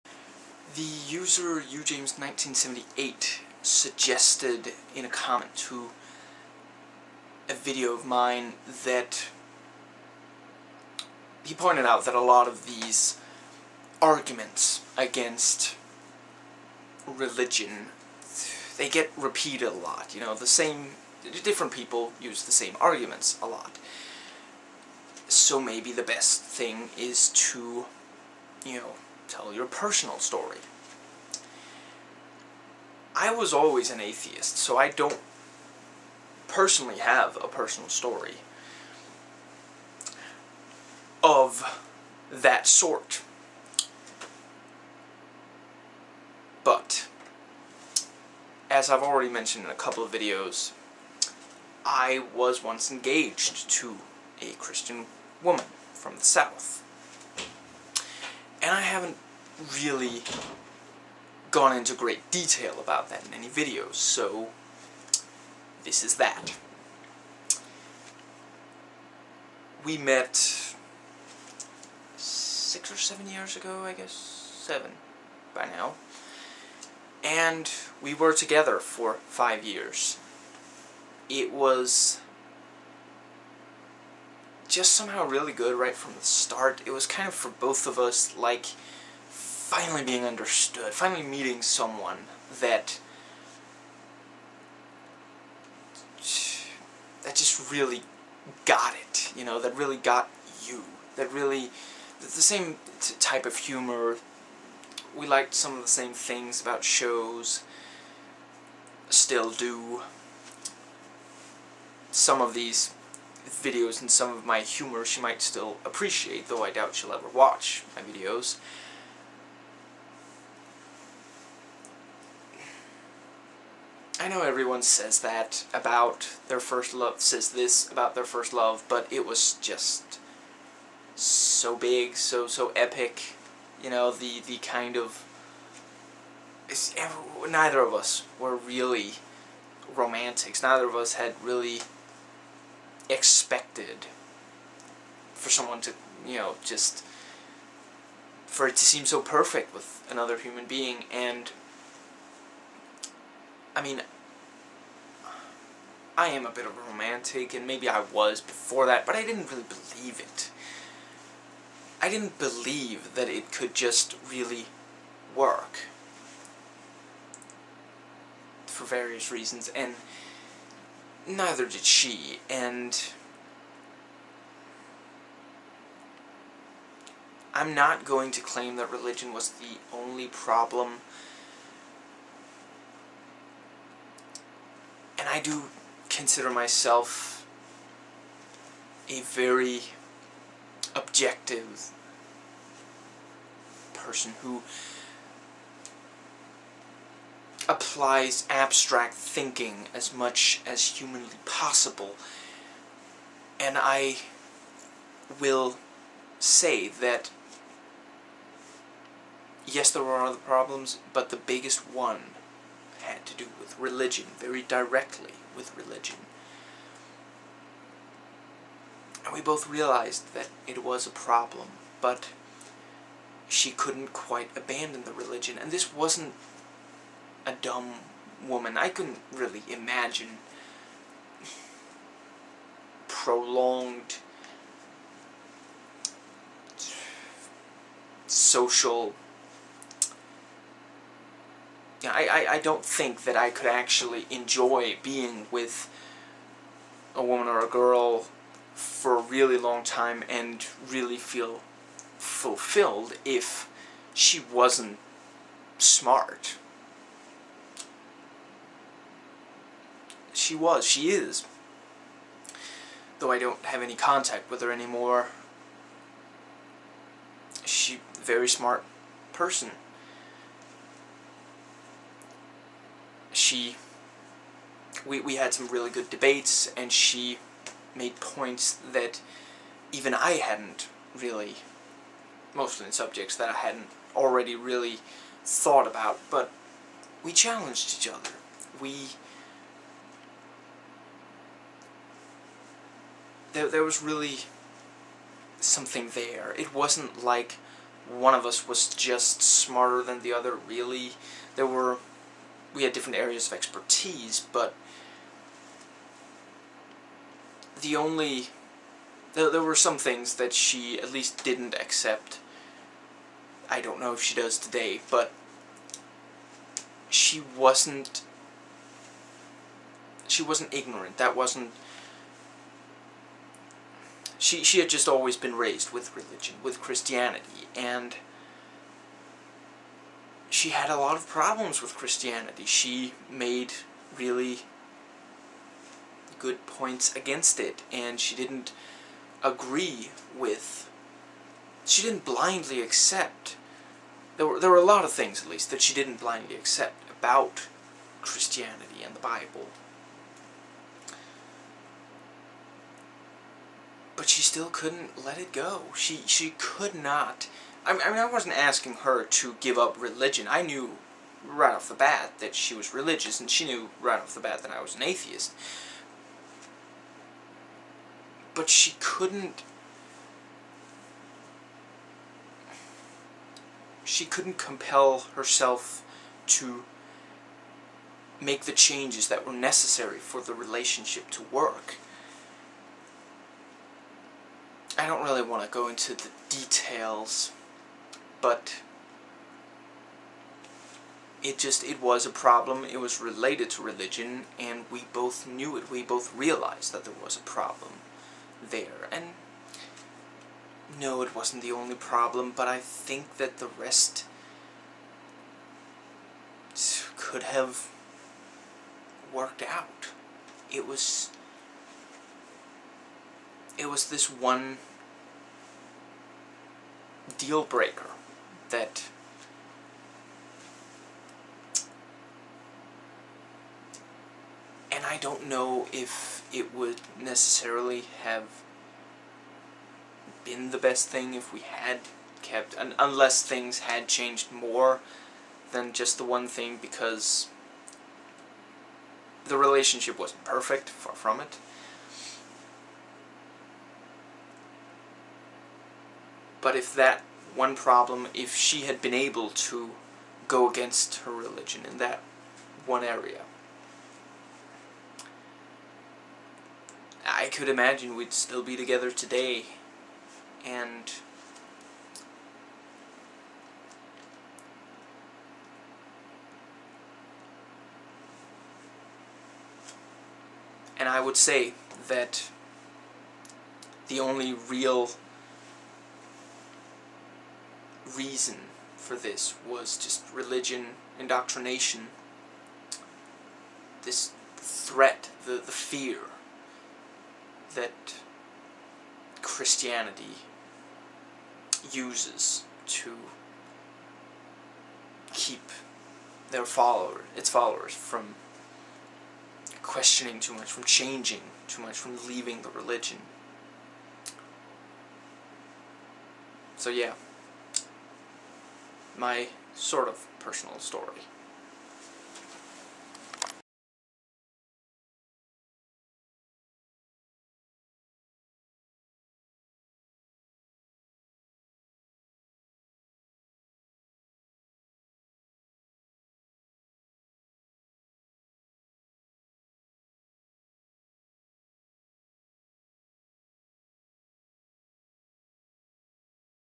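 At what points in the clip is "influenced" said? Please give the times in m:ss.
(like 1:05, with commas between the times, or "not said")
not said.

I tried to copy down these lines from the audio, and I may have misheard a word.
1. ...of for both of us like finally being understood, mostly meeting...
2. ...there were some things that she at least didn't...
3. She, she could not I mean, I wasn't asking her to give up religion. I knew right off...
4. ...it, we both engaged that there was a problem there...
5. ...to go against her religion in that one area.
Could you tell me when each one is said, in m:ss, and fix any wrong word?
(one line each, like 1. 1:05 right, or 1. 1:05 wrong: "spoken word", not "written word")
1. 1:27 wrong: "finally", not "mostly"
2. 5:09 right
3. 5:55 right
4. 6:35 wrong: "realized", not "engaged"
5. 7:29 right.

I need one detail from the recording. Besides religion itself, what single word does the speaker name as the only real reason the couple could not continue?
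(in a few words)
indoctrination.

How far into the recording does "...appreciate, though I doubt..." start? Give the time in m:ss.
1:55.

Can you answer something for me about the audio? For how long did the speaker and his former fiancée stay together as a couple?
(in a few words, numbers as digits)
5 years.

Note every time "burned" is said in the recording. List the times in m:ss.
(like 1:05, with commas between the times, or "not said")
not said.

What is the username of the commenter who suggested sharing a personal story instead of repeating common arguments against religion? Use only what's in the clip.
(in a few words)
ujames1978.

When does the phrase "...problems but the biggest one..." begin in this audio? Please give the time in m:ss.
3:30.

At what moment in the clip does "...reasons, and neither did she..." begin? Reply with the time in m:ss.
2:49.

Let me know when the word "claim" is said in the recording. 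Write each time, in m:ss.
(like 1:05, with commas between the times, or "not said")
2:58.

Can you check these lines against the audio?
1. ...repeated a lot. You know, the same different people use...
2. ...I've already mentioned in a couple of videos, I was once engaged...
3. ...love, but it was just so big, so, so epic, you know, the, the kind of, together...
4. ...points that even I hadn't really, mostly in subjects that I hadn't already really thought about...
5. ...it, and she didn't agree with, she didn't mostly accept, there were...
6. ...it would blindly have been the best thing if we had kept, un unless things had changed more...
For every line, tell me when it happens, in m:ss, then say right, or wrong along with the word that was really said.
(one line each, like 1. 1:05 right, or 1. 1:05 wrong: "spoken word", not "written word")
1. 0:19 right
2. 0:48 right
3. 2:08 wrong: "neither", not "together"
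4. 4:38 right
5. 5:37 wrong: "blindly", not "mostly"
6. 7:06 wrong: "necessarily", not "blindly".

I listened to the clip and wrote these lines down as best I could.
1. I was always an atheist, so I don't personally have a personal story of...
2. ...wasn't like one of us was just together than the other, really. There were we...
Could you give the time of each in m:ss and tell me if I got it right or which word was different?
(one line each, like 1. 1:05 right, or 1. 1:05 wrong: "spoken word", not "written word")
1. 0:33 right
2. 4:56 wrong: "smarter", not "together".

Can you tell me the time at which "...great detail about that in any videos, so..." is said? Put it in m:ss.
1:01.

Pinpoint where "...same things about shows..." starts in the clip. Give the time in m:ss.
1:45.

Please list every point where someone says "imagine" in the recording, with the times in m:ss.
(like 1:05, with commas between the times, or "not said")
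3:49, 7:37.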